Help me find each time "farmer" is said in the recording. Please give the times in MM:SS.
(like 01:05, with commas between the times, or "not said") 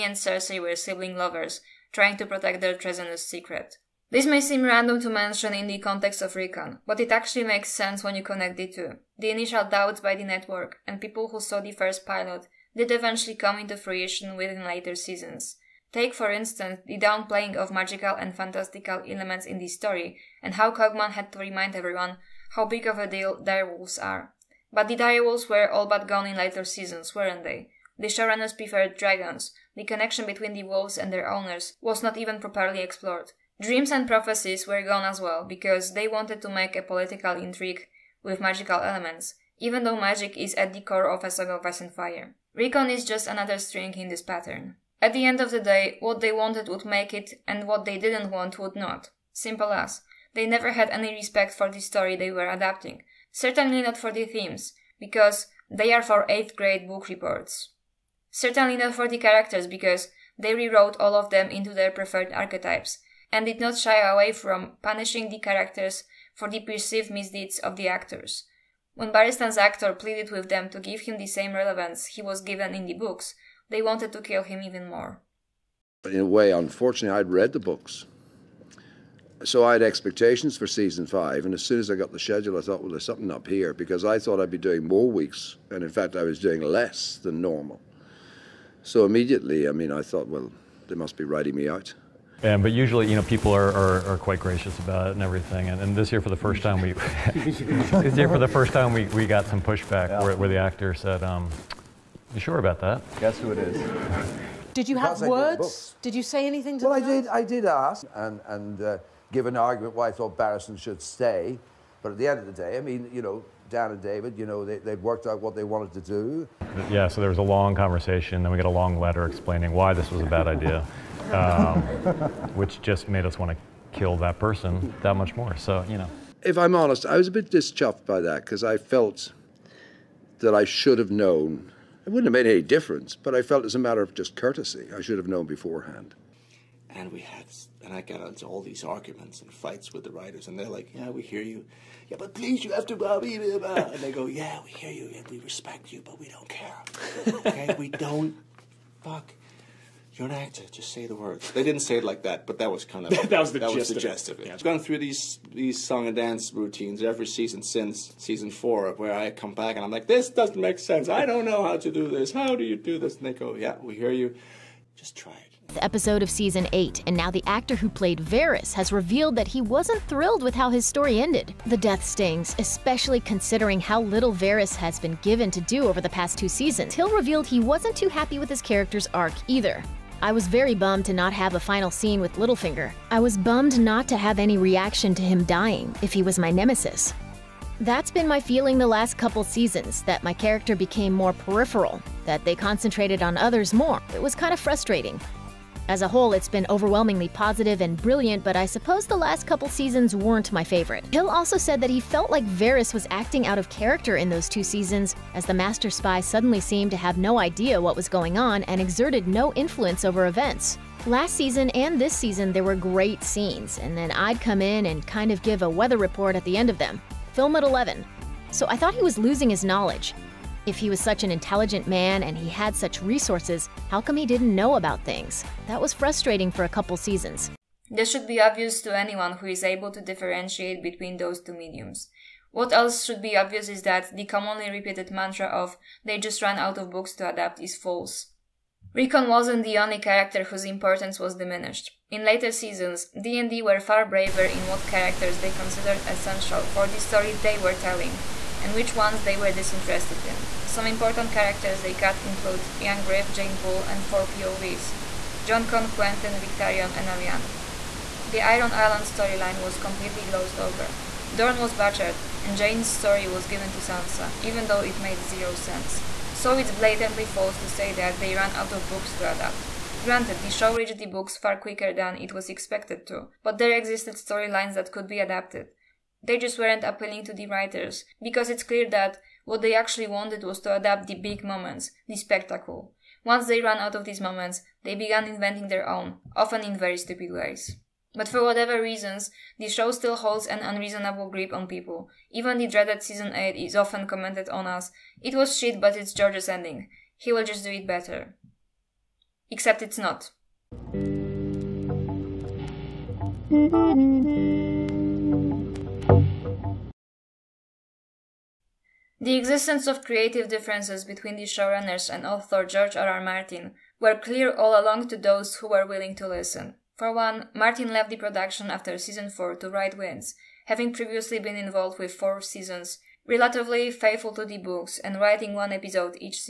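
not said.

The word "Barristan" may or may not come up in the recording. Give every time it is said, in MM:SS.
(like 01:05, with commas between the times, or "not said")
01:09, 01:50.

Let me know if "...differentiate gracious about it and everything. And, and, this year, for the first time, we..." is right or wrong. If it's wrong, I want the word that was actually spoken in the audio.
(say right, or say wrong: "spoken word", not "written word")
wrong: "quite", not "differentiate".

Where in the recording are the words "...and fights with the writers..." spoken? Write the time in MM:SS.
02:19.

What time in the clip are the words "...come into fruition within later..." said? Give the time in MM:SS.
00:13.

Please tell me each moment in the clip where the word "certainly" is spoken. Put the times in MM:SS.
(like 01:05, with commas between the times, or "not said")
00:53, 00:58.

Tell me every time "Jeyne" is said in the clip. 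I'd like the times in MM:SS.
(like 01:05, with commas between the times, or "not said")
04:13, 04:22.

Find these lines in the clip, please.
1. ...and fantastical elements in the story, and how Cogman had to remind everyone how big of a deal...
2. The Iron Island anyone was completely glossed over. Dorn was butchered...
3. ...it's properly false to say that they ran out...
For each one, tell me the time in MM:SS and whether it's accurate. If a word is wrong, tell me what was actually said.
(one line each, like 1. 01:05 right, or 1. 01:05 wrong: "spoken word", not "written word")
1. 00:18 right
2. 04:18 wrong: "storyline", not "anyone"
3. 04:26 wrong: "blatantly", not "properly".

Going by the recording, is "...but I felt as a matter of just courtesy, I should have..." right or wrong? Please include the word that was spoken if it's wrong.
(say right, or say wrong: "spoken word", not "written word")
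right.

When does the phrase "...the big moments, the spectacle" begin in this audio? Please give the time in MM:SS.
04:41.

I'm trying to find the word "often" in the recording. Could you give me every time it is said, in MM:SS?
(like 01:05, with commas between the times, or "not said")
04:46, 04:53.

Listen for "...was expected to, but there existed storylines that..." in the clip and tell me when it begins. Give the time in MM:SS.
04:32.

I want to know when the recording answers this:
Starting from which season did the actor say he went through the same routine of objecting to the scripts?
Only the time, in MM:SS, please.
02:38.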